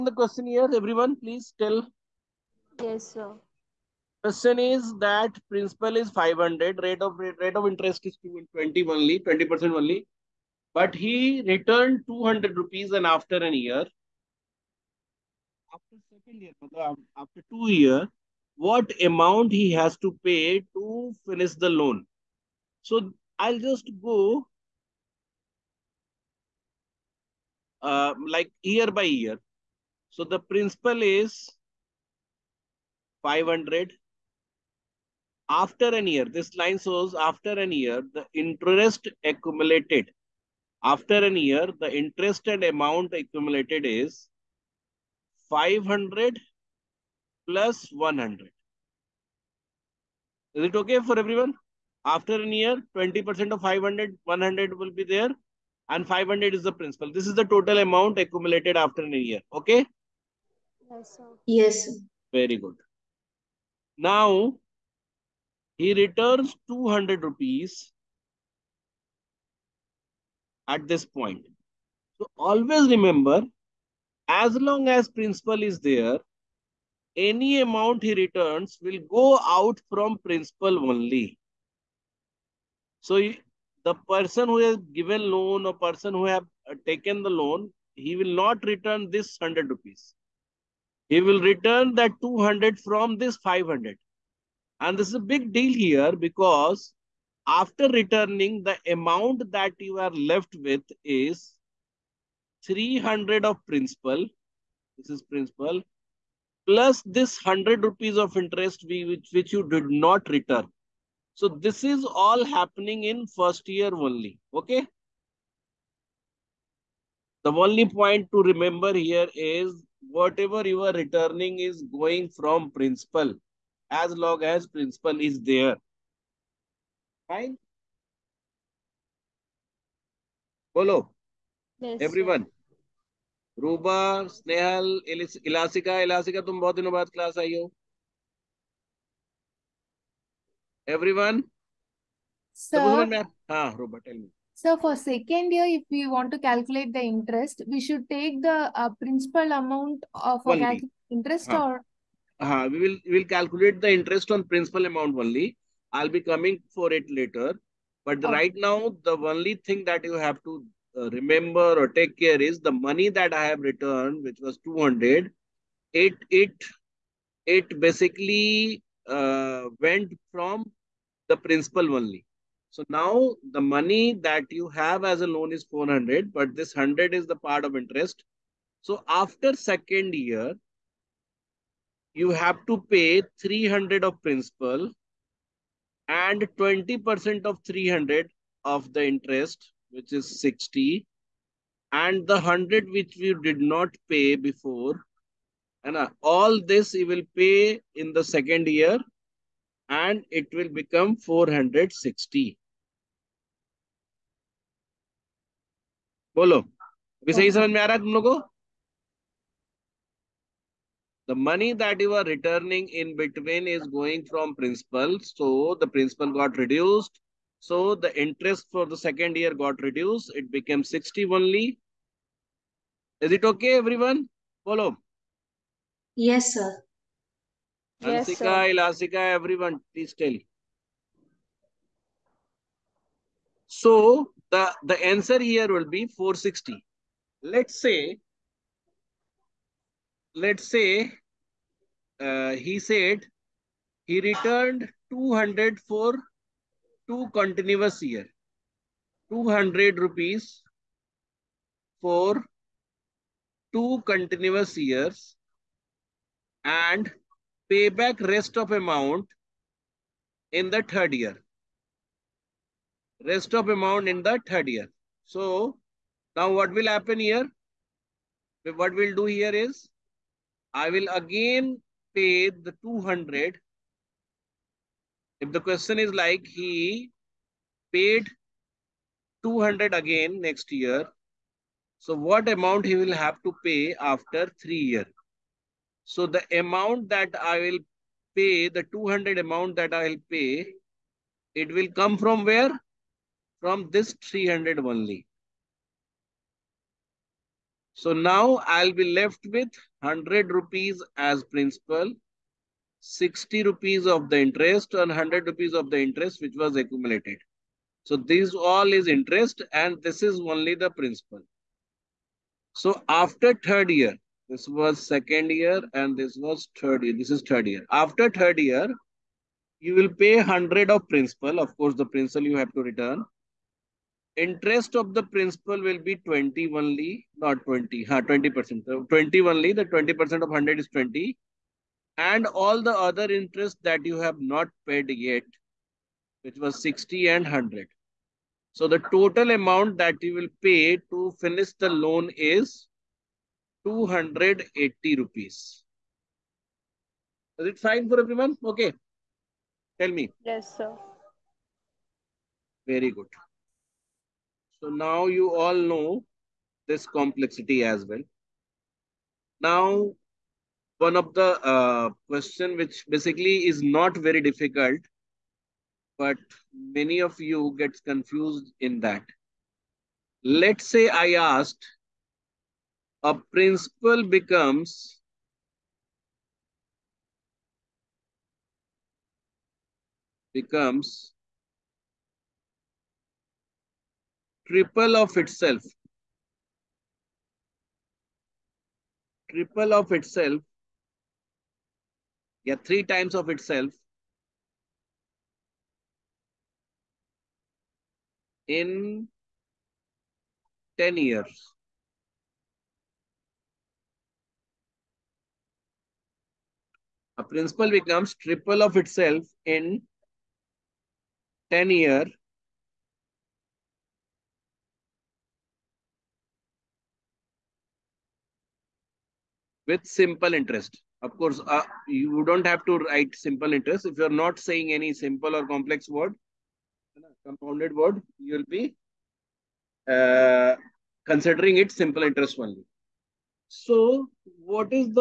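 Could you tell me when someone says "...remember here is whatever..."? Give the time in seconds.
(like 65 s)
118 s.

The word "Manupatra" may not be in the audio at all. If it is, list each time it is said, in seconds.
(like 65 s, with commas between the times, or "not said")
not said.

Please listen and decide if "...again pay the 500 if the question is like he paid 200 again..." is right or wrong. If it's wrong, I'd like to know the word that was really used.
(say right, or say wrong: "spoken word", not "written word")
wrong: "200", not "500".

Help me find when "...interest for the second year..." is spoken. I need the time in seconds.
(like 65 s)
218 s.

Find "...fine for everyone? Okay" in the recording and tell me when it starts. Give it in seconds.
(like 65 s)
347 s.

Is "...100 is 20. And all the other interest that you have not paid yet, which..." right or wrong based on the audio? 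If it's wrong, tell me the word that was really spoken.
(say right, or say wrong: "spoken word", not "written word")
right.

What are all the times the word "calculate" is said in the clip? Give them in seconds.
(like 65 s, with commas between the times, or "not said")
146 s, 153 s.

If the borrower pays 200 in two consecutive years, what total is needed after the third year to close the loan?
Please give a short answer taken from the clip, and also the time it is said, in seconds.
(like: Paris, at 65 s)
280 rupees, at 343 s.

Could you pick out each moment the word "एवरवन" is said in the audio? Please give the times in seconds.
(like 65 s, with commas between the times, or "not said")
132 s, 140 s.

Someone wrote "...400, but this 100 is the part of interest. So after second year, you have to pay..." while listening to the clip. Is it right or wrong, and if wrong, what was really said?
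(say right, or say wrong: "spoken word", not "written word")
right.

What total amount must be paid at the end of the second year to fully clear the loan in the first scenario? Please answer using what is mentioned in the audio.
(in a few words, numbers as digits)
460.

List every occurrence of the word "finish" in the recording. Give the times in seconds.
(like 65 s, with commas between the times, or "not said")
21 s, 341 s.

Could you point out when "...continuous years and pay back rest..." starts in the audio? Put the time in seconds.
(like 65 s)
254 s.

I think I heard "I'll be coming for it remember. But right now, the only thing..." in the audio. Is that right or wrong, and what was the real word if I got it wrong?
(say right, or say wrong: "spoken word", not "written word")
wrong: "later", not "remember".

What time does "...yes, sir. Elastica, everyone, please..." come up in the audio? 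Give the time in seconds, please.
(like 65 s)
228 s.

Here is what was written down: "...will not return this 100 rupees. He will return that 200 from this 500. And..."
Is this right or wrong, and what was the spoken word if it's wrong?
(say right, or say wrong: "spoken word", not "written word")
right.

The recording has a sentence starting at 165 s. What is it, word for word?
It it it basically uh, went from the principal only.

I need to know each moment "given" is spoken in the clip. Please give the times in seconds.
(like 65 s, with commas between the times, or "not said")
84 s.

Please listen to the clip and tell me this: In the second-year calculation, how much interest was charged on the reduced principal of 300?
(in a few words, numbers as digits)
60.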